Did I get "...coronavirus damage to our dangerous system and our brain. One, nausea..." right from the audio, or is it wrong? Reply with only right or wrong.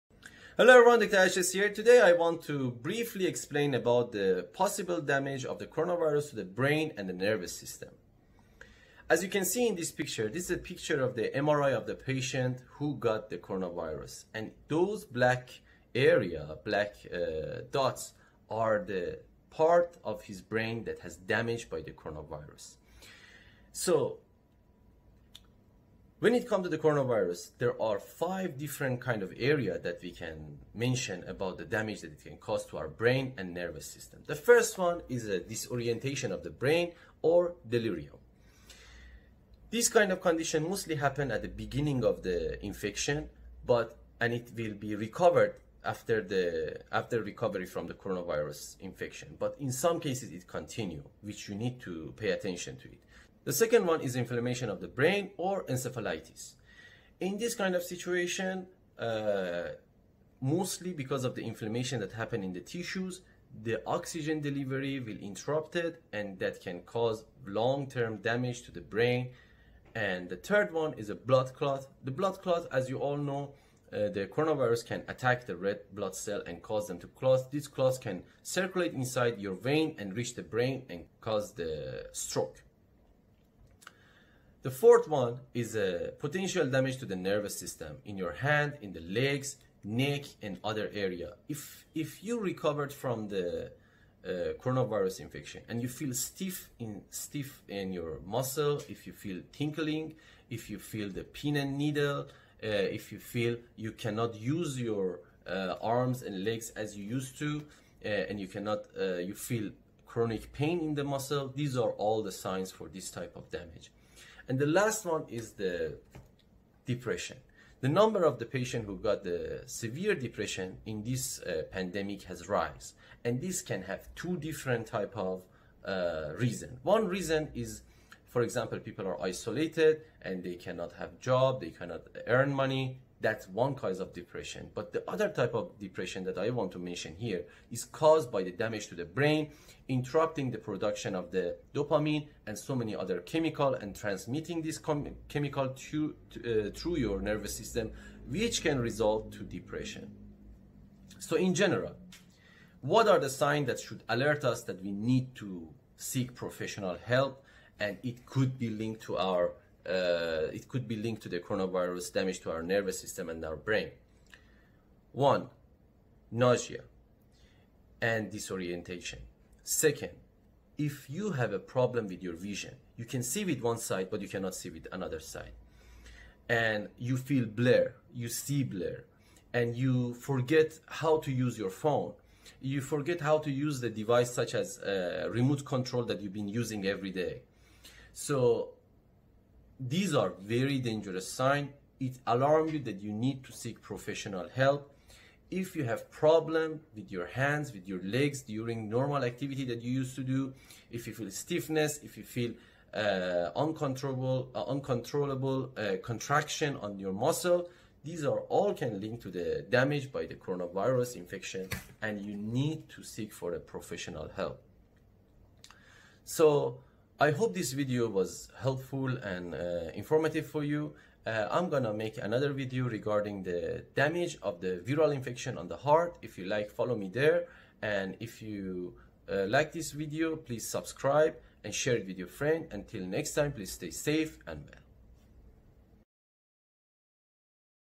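wrong.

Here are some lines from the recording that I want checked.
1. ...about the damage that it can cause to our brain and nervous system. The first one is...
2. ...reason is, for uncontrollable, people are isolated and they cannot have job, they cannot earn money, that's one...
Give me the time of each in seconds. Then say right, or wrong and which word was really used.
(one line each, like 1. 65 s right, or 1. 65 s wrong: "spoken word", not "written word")
1. 31 s right
2. 127 s wrong: "example", not "uncontrollable".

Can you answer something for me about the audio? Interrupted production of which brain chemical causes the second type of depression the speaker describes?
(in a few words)
Dopamine.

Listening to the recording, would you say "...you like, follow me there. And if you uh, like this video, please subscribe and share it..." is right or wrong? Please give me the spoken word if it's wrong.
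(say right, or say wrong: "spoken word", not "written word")
right.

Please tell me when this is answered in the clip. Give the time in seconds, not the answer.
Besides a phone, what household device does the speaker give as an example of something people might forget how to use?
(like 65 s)
185 s.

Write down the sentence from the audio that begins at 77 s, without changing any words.
These clots can circulate inside your vein and reach the brain and cause the stroke.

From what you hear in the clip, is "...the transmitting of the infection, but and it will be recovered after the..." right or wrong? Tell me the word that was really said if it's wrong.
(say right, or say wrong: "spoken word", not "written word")
wrong: "beginning", not "transmitting".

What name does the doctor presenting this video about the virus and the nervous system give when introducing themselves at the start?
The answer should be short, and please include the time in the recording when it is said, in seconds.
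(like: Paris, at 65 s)
Arshia, at 1 s.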